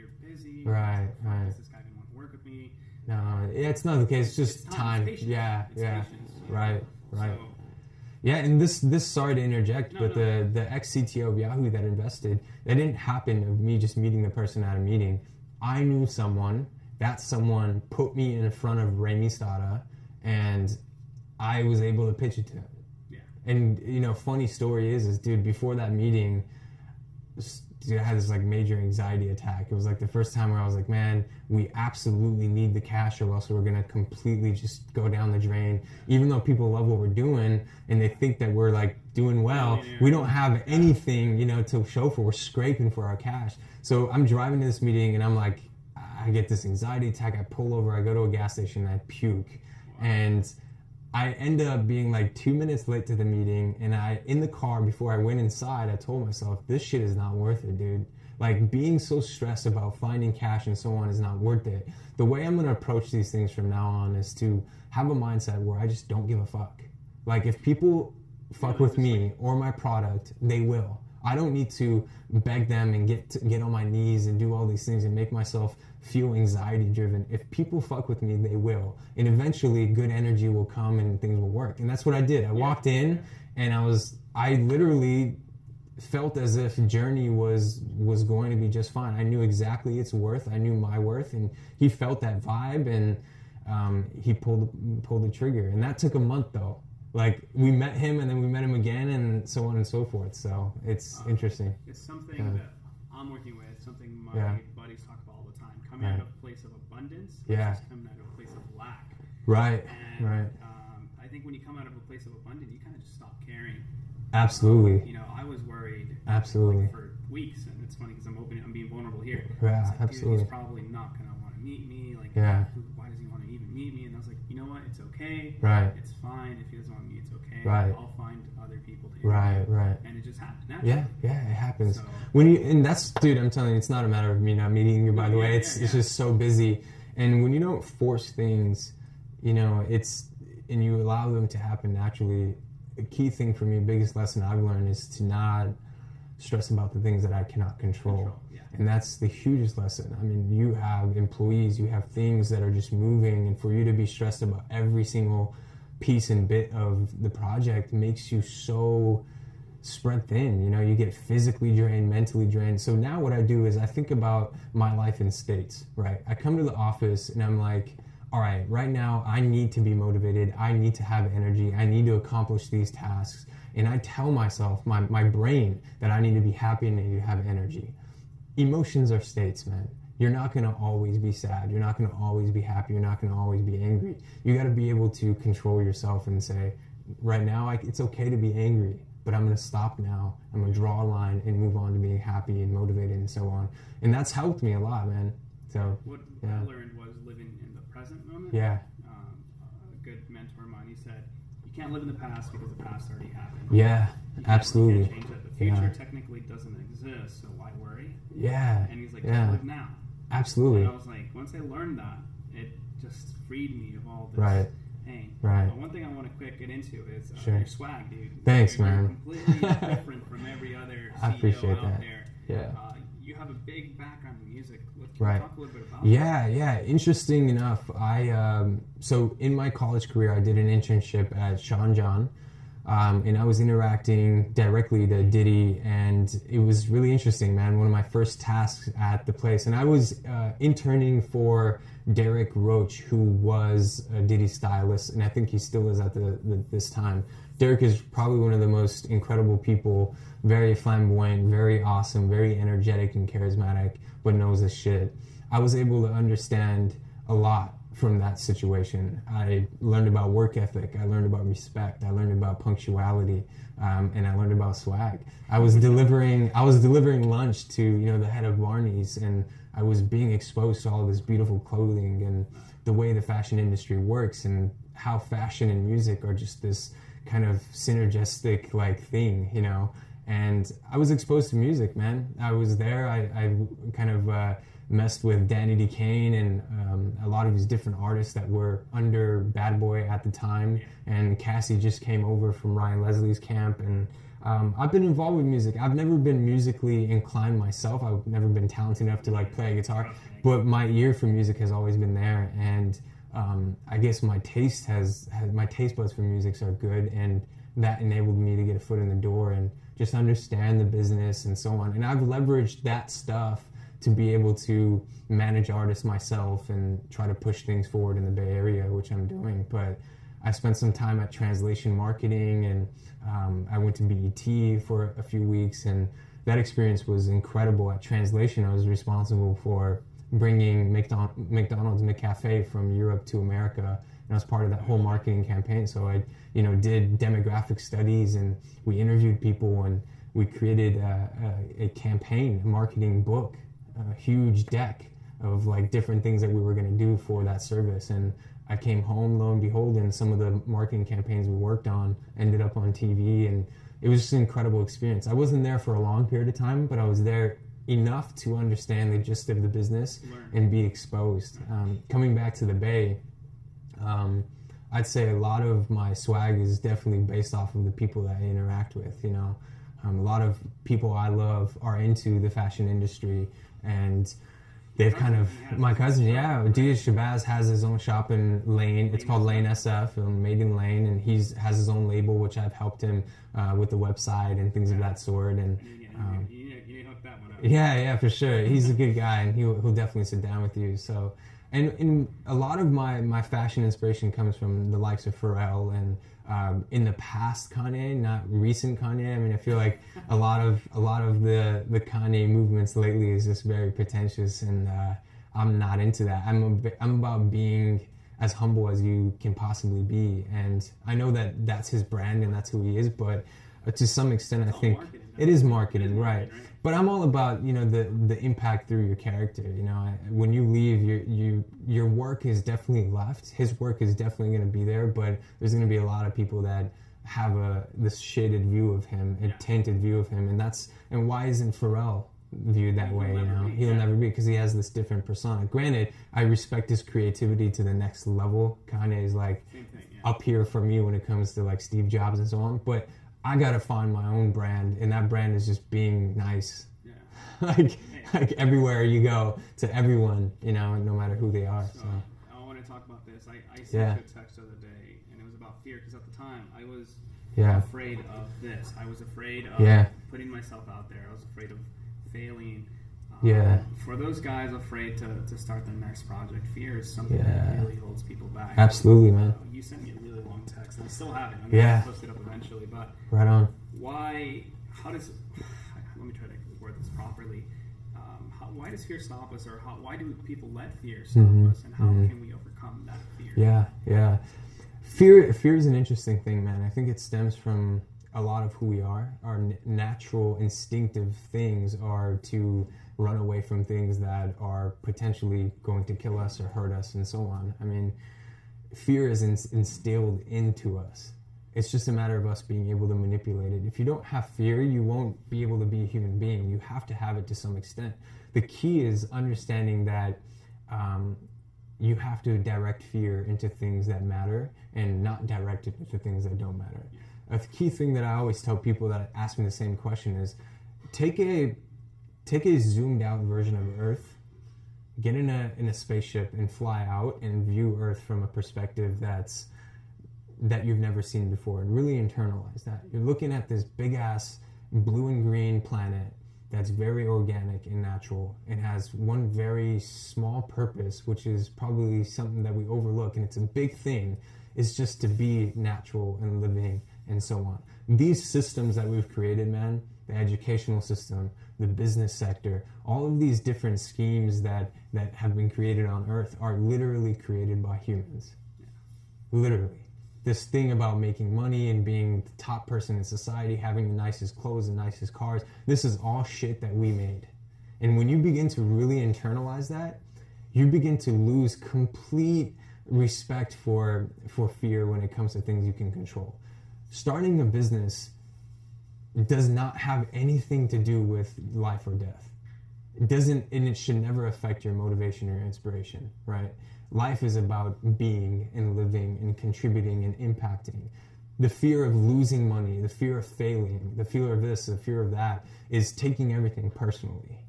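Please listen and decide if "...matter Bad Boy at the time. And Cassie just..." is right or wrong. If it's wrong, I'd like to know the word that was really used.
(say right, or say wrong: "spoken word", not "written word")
wrong: "under", not "matter".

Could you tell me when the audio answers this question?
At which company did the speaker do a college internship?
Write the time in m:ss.
3:51.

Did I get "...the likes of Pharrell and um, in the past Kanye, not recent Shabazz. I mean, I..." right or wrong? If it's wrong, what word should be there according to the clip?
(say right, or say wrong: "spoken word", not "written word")
wrong: "Kanye", not "Shabazz".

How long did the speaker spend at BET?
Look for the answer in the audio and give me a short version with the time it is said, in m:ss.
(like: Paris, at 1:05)
A few weeks, at 5:25.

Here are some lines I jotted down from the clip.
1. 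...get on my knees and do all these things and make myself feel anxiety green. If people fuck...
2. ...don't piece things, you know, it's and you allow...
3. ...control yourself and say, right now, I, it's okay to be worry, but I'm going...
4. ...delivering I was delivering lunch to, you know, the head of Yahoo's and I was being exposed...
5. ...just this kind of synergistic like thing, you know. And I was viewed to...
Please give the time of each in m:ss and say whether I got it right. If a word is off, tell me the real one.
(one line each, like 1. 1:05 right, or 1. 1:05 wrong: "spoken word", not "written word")
1. 1:13 wrong: "driven", not "green"
2. 2:17 wrong: "force", not "piece"
3. 3:05 wrong: "angry", not "worry"
4. 4:25 wrong: "Barney", not "Yahoo"
5. 4:36 wrong: "exposed", not "viewed".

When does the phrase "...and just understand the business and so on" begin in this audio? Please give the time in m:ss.
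5:09.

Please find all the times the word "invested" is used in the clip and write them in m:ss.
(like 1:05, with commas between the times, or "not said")
0:11.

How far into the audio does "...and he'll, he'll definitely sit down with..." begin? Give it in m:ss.
6:29.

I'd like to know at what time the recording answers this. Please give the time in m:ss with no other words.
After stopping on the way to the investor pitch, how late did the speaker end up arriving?
0:52.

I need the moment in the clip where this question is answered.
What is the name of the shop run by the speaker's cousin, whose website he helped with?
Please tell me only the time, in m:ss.
6:19.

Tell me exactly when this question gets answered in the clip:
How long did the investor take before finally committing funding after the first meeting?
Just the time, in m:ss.
1:36.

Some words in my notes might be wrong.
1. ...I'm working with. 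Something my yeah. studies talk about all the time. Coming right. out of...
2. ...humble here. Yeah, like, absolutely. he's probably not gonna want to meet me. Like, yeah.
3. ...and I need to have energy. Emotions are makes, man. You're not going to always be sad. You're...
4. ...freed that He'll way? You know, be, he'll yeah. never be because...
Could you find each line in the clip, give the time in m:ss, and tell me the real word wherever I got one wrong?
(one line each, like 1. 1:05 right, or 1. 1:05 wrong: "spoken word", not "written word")
1. 1:43 wrong: "buddies", not "studies"
2. 1:58 wrong: "vulnerable", not "humble"
3. 2:56 wrong: "states", not "makes"
4. 7:12 wrong: "viewed", not "freed".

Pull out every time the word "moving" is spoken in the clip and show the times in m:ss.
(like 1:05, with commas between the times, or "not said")
2:32.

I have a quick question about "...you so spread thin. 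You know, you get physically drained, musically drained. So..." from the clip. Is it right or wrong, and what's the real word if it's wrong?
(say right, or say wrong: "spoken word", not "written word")
wrong: "mentally", not "musically".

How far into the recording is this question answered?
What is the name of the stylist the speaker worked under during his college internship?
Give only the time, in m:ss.
4:02.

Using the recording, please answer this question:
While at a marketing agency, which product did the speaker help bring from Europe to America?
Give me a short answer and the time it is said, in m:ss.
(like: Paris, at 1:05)
McDonald's McCafe, at 5:32.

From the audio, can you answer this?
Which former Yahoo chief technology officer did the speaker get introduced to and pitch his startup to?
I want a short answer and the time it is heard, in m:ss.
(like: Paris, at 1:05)
Raymie Stata, at 0:18.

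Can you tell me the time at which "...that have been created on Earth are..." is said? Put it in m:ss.
9:15.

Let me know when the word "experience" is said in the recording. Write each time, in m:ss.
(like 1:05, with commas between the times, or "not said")
5:26, 5:54.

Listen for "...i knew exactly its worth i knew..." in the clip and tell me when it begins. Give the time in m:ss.
1:29.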